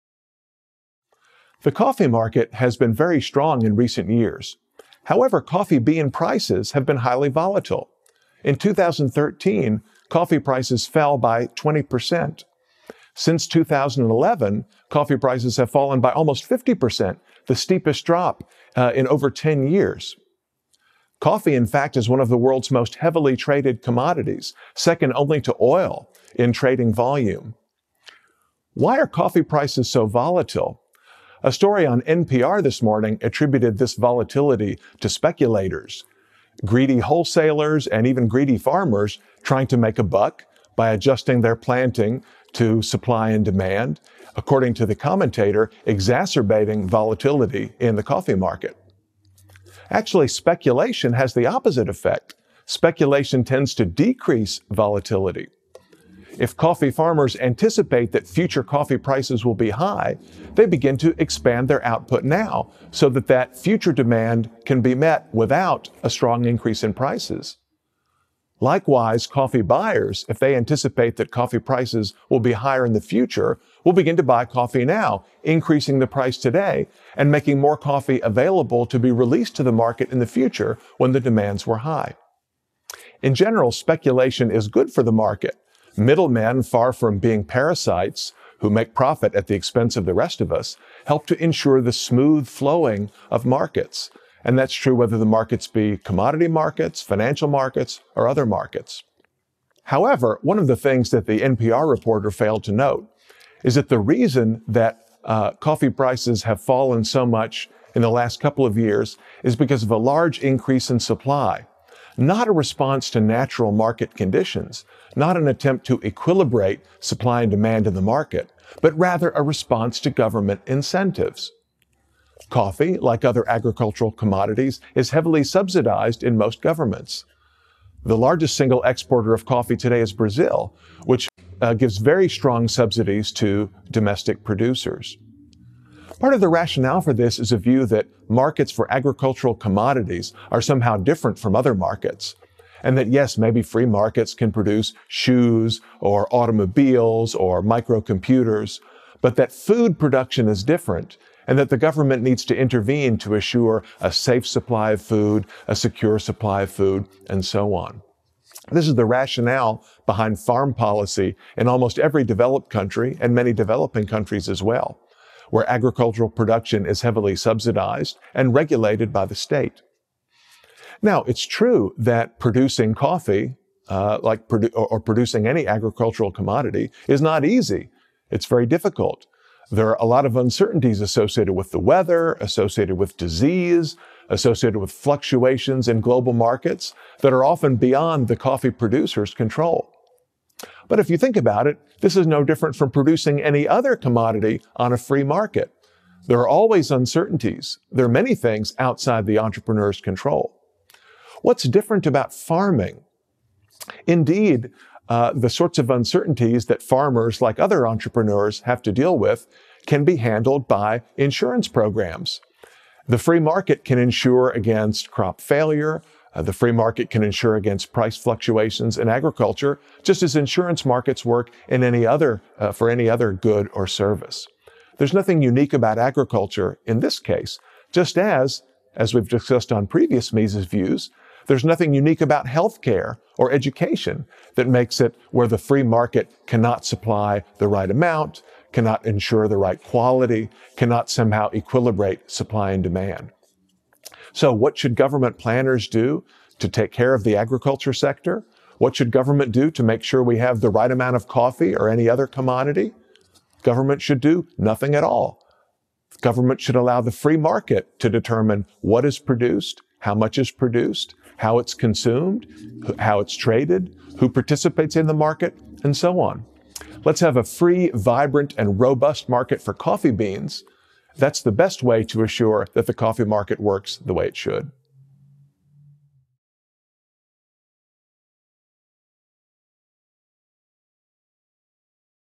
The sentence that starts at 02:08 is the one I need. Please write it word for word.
The largest single exporter of coffee today is Brazil, which uh, gives very strong subsidies to domestic producers.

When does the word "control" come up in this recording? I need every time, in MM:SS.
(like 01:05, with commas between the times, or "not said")
03:09, 03:20.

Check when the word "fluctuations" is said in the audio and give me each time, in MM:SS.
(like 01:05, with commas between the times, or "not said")
03:04, 03:38.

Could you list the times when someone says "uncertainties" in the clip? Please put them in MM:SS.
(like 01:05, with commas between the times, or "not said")
03:00, 03:16, 03:25.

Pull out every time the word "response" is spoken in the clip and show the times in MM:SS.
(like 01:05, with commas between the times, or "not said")
01:52, 01:59.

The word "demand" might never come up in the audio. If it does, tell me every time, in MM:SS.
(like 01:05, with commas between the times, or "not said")
00:43, 01:03, 01:21, 01:57, 04:02.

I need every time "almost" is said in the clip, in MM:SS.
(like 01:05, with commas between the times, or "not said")
00:16, 02:41.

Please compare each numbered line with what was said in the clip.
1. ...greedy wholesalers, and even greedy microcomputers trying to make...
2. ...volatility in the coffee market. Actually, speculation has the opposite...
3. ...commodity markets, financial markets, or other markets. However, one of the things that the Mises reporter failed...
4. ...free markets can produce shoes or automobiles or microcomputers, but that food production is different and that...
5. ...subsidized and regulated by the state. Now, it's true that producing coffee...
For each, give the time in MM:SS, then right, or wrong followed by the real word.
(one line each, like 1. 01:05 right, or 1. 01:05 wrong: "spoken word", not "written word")
1. 00:36 wrong: "farmers", not "microcomputers"
2. 00:46 right
3. 01:35 wrong: "NPR", not "Mises"
4. 02:23 right
5. 02:47 right.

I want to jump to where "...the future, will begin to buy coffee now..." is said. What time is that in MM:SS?
01:12.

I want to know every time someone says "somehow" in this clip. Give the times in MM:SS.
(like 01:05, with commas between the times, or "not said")
02:20, 04:01.